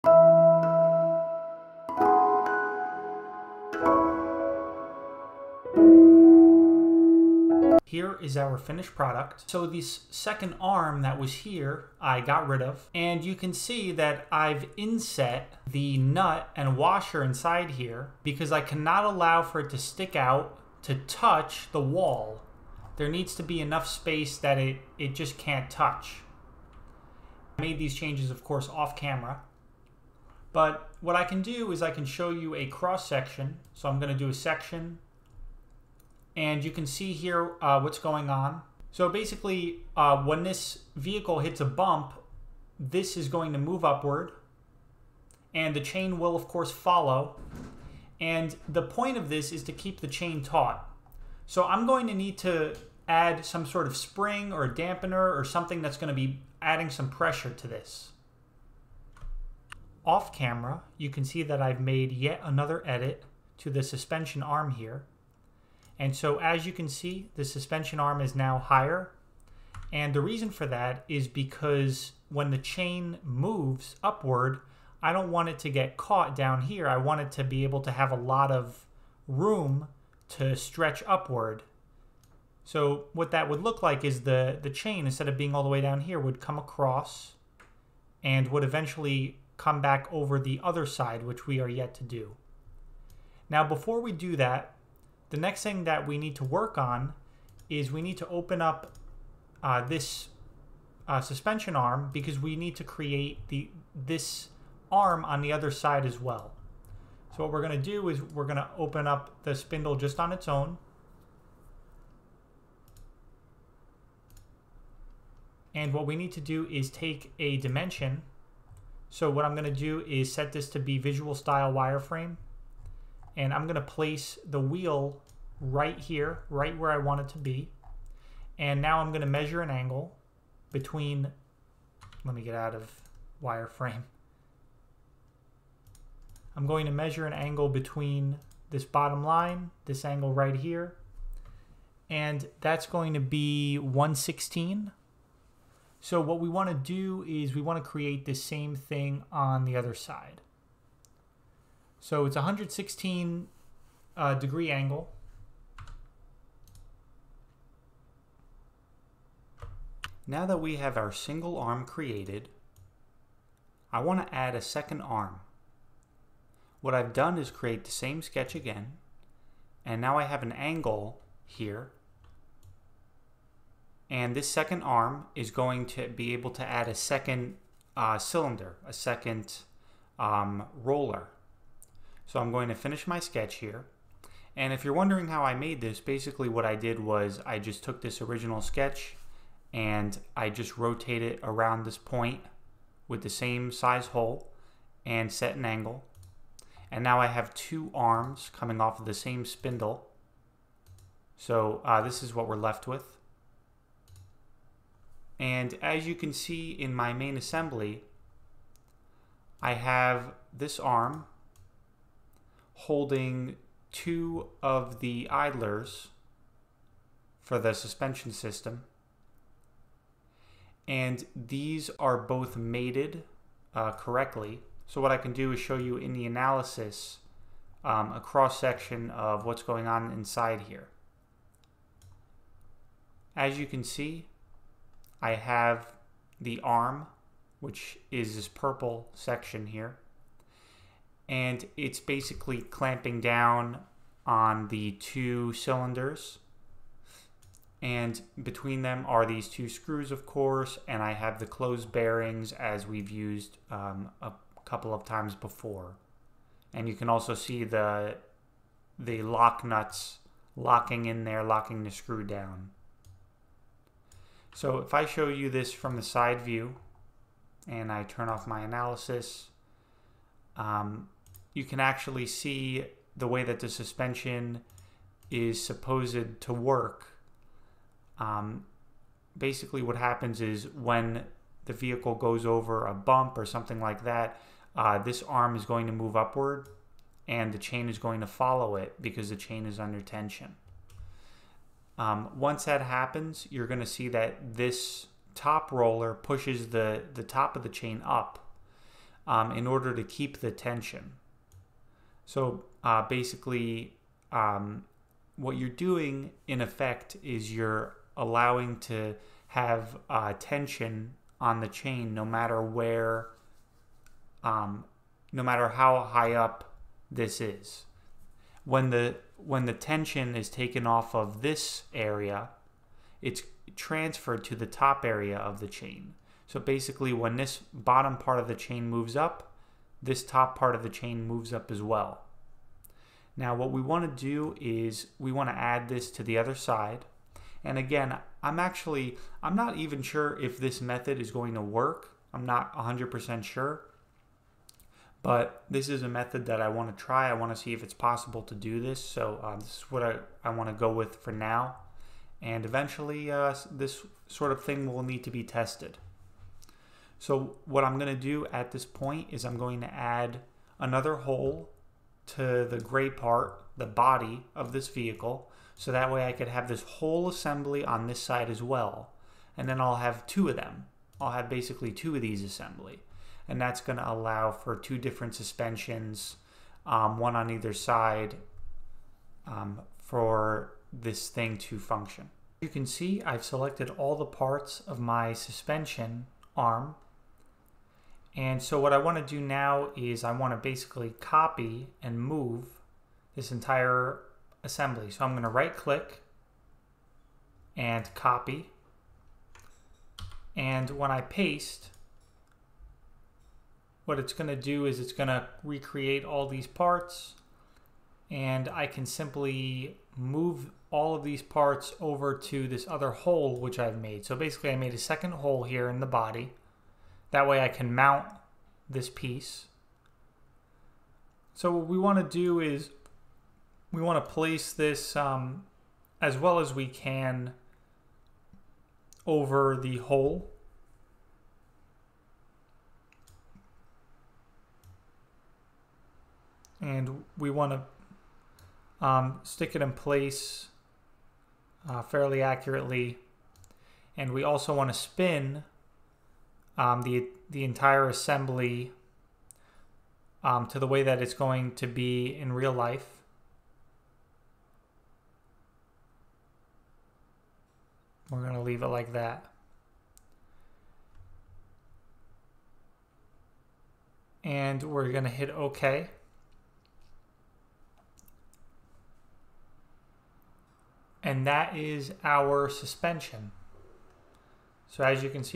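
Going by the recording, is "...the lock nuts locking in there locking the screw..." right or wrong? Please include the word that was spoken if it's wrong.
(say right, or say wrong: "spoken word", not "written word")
right.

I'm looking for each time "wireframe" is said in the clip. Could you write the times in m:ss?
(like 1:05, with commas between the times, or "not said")
2:01, 2:13.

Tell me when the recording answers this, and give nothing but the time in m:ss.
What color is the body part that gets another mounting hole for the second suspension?
6:02.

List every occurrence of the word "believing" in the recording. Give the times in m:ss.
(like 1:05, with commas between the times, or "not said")
not said.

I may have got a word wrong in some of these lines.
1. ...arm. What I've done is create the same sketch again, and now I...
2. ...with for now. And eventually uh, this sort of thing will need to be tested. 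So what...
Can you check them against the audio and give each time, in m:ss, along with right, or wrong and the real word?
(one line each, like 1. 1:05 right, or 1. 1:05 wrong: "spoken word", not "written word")
1. 2:45 right
2. 5:50 right.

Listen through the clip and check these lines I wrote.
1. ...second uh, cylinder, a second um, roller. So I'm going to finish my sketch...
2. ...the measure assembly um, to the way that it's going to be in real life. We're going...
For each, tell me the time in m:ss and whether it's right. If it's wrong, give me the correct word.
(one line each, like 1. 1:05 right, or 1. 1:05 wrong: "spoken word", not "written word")
1. 2:56 right
2. 7:27 wrong: "entire", not "measure".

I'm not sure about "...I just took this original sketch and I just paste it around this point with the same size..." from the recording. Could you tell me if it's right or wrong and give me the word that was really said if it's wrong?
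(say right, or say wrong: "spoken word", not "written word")
wrong: "rotate", not "paste".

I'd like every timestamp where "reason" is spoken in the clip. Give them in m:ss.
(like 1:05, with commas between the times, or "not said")
1:10.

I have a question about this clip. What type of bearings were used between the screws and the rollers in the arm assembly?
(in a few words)
closed bearings.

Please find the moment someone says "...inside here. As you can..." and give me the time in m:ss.
3:50.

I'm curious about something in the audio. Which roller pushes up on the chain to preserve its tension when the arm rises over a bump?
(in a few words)
top roller.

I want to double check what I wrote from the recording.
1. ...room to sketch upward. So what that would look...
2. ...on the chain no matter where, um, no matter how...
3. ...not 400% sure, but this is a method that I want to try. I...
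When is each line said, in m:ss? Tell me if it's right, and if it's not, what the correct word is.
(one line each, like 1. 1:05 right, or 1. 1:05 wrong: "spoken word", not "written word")
1. 1:19 wrong: "stretch", not "sketch"
2. 5:11 right
3. 5:42 wrong: "100", not "400".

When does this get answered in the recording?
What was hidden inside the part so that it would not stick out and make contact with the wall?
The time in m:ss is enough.
0:15.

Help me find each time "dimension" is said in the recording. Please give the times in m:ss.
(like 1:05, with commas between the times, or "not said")
1:57.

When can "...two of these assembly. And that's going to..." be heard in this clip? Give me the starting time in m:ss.
6:11.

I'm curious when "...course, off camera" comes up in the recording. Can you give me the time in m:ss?
0:28.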